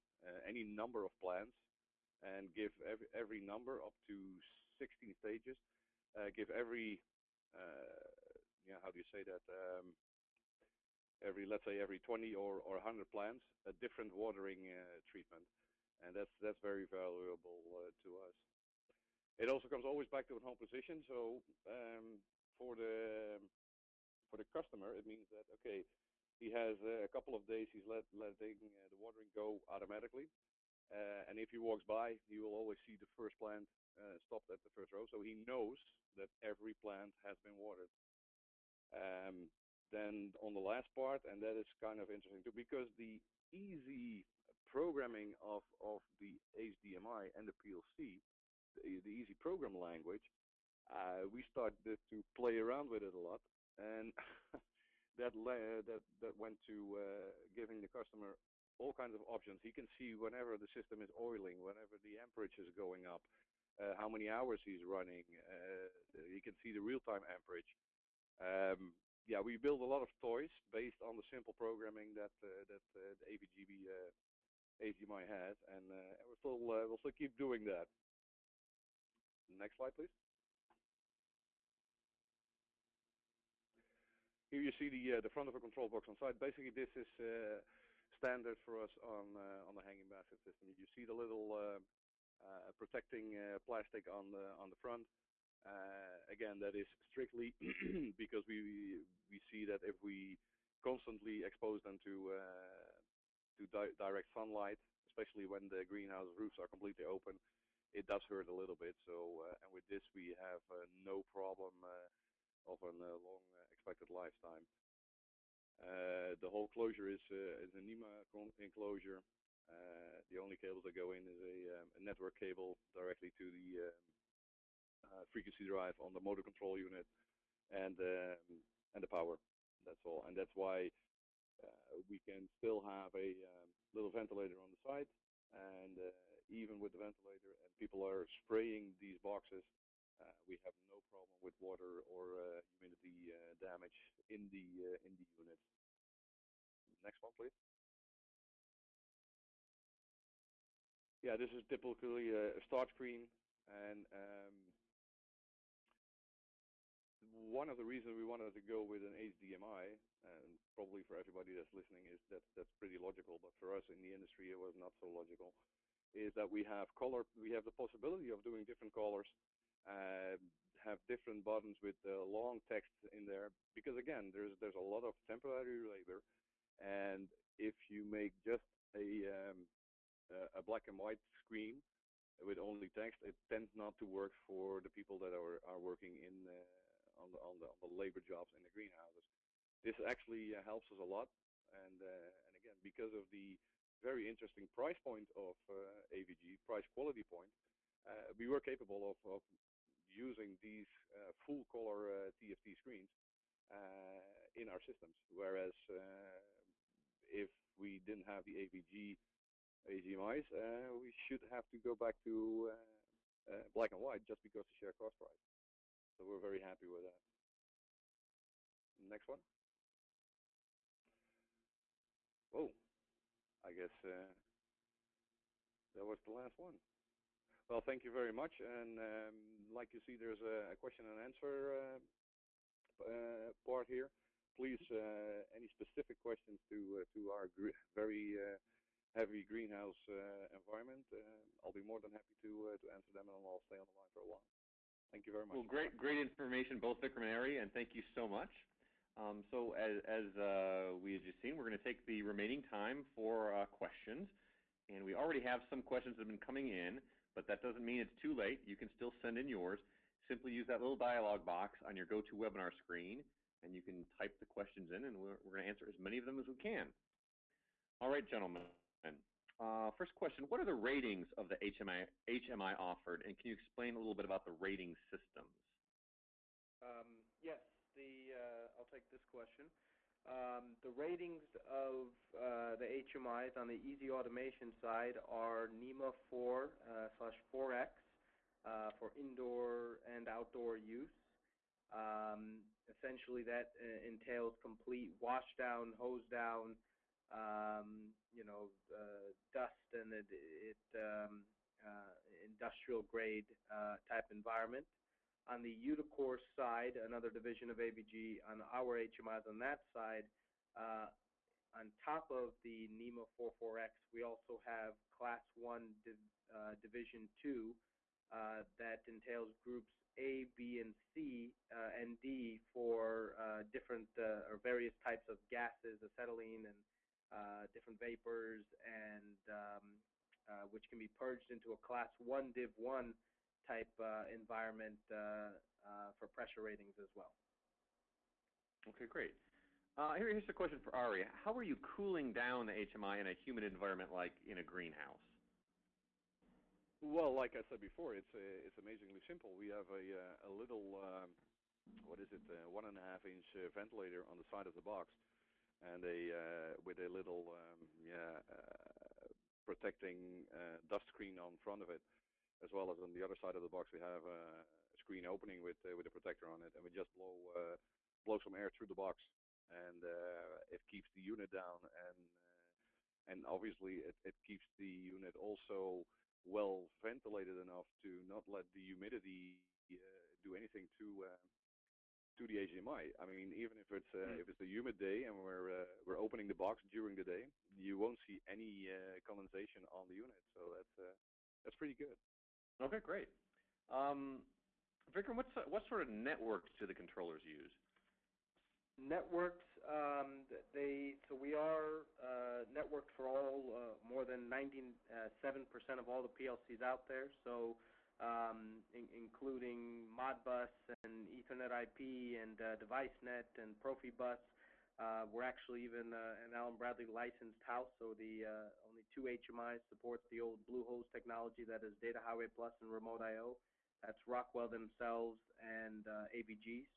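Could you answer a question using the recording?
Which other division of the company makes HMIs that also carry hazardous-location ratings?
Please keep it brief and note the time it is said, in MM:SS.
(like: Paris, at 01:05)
Uticor, at 05:05.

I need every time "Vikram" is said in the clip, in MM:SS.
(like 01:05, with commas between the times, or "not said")
04:06, 06:35.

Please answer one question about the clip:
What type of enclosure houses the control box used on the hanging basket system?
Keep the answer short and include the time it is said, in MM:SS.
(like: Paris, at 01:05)
NEMA enclosure, at 01:57.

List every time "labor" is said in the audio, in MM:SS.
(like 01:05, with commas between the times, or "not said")
02:55, 03:07.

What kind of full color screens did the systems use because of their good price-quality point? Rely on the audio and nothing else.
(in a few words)
TFT.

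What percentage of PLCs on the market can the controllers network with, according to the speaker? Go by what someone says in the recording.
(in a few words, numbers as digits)
97%.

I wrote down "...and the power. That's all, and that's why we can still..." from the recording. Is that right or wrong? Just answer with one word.
right.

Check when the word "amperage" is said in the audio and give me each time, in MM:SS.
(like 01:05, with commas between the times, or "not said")
01:02, 01:07.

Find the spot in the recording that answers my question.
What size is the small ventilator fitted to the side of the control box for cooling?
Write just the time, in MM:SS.
05:52.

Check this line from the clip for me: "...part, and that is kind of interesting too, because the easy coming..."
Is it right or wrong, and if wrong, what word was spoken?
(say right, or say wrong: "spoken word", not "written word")
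wrong: "programming", not "coming".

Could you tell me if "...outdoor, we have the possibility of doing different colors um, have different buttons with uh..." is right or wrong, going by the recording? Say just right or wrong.
wrong.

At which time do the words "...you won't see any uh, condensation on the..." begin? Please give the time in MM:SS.
06:27.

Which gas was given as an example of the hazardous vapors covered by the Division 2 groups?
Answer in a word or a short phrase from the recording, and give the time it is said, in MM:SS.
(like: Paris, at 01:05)
acetylene, at 05:26.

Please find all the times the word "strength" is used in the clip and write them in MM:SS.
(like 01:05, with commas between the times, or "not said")
not said.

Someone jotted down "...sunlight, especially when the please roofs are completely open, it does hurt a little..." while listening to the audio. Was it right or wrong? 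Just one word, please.
wrong.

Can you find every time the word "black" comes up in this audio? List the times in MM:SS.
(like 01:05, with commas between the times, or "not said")
03:00, 03:33.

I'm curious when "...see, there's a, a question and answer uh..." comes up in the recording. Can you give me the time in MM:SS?
03:50.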